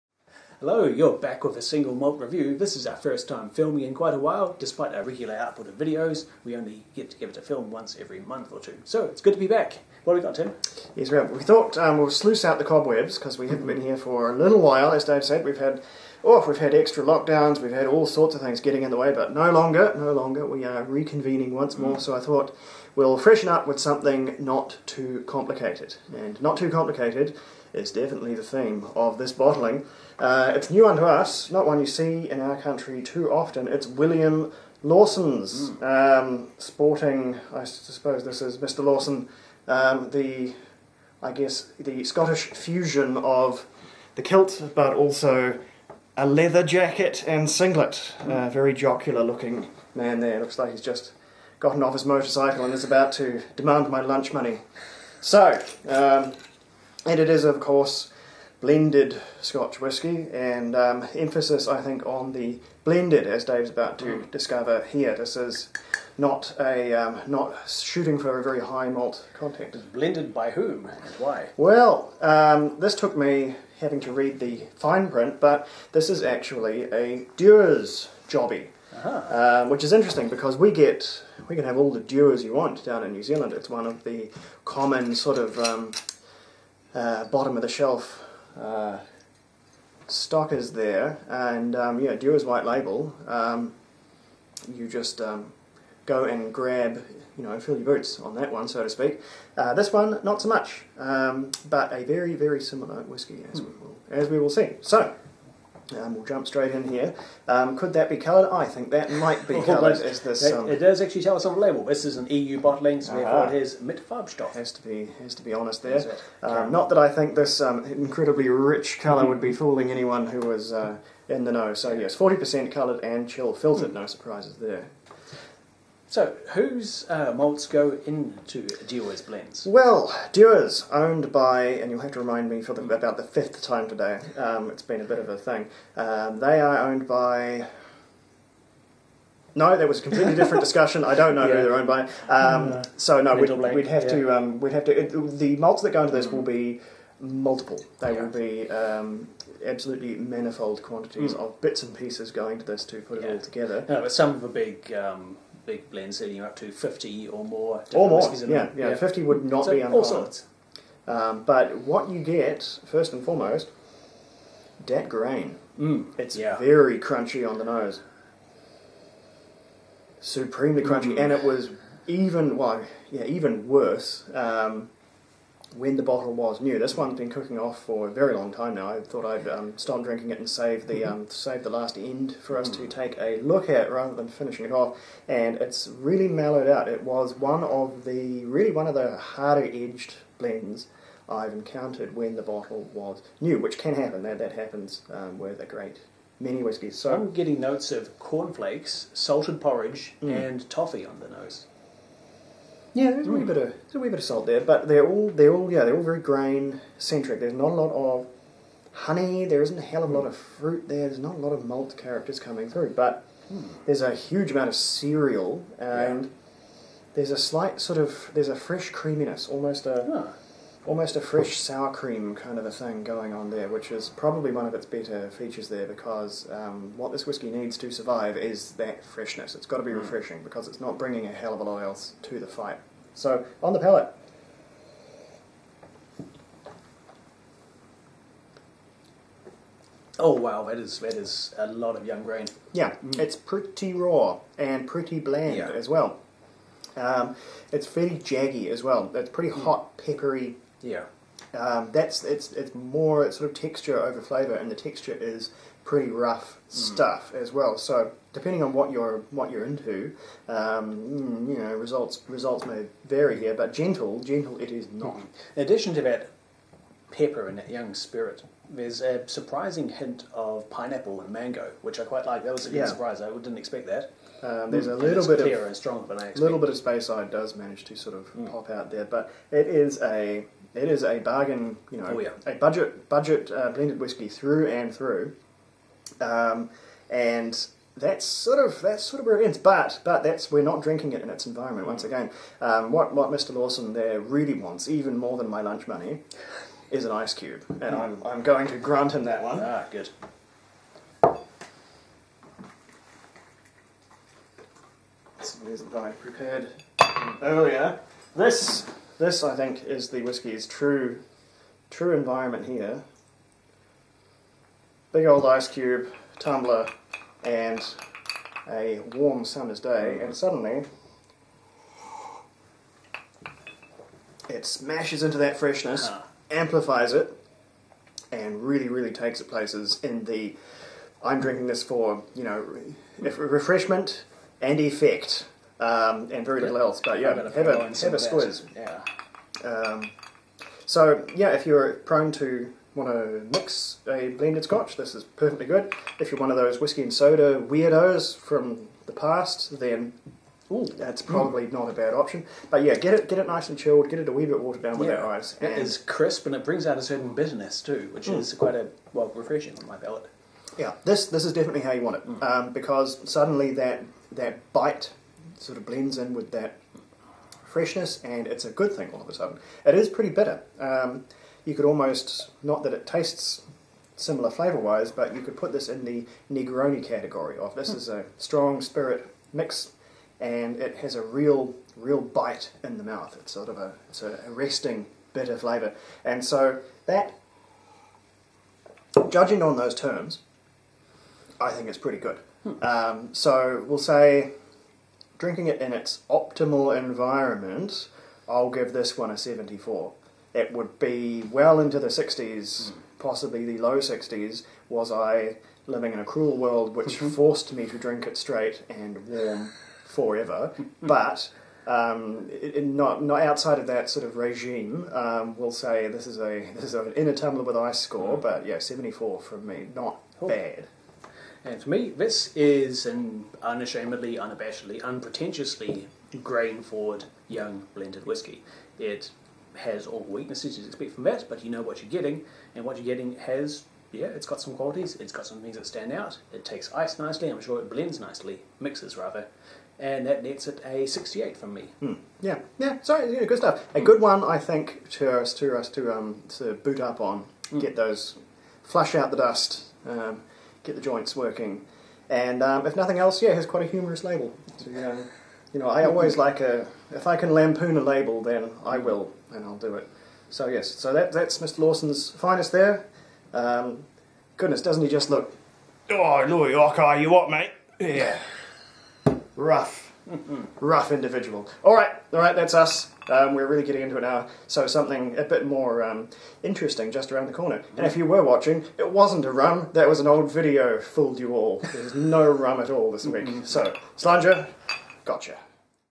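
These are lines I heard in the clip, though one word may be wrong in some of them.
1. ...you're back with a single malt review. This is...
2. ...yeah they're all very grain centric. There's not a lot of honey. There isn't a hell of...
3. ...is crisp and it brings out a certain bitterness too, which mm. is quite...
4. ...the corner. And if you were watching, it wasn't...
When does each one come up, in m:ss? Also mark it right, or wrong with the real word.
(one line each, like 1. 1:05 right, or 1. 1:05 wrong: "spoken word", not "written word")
1. 0:00 right
2. 3:25 right
3. 5:55 right
4. 7:57 right.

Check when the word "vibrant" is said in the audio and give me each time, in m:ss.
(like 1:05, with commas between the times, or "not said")
not said.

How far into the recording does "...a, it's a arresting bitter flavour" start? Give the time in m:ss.
6:23.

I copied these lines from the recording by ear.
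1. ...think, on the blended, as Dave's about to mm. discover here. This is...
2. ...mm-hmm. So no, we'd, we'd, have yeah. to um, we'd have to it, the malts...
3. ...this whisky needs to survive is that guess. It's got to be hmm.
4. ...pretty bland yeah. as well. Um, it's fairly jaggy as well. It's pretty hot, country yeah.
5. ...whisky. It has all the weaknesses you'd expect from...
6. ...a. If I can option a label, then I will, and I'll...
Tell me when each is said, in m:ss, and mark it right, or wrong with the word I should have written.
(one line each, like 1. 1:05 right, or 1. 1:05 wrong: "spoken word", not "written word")
1. 1:01 right
2. 2:22 right
3. 3:47 wrong: "freshness", not "guess"
4. 4:04 wrong: "peppery", not "country"
5. 7:08 right
6. 7:36 wrong: "lampoon", not "option".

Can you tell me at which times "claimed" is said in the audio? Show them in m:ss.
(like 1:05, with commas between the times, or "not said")
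not said.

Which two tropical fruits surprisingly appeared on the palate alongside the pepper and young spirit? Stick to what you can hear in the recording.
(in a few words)
pineapple and mango.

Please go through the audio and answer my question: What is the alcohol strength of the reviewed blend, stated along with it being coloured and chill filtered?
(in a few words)
40 percent.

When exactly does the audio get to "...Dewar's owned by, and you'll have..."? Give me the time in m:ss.
2:10.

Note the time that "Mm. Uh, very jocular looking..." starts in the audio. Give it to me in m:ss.
0:48.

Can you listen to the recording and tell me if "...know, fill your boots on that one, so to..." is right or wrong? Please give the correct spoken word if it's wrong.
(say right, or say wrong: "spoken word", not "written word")
right.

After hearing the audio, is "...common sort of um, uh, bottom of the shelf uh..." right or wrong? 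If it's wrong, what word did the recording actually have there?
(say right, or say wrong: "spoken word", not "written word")
right.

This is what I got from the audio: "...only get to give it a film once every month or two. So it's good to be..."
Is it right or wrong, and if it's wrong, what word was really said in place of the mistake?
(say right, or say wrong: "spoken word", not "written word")
right.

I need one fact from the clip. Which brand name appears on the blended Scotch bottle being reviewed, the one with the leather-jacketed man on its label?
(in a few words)
William Lawson's.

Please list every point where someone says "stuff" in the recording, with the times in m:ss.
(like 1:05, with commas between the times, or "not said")
4:16, 7:23.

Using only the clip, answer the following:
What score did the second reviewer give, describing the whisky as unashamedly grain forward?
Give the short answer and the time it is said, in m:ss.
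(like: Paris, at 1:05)
68, at 7:21.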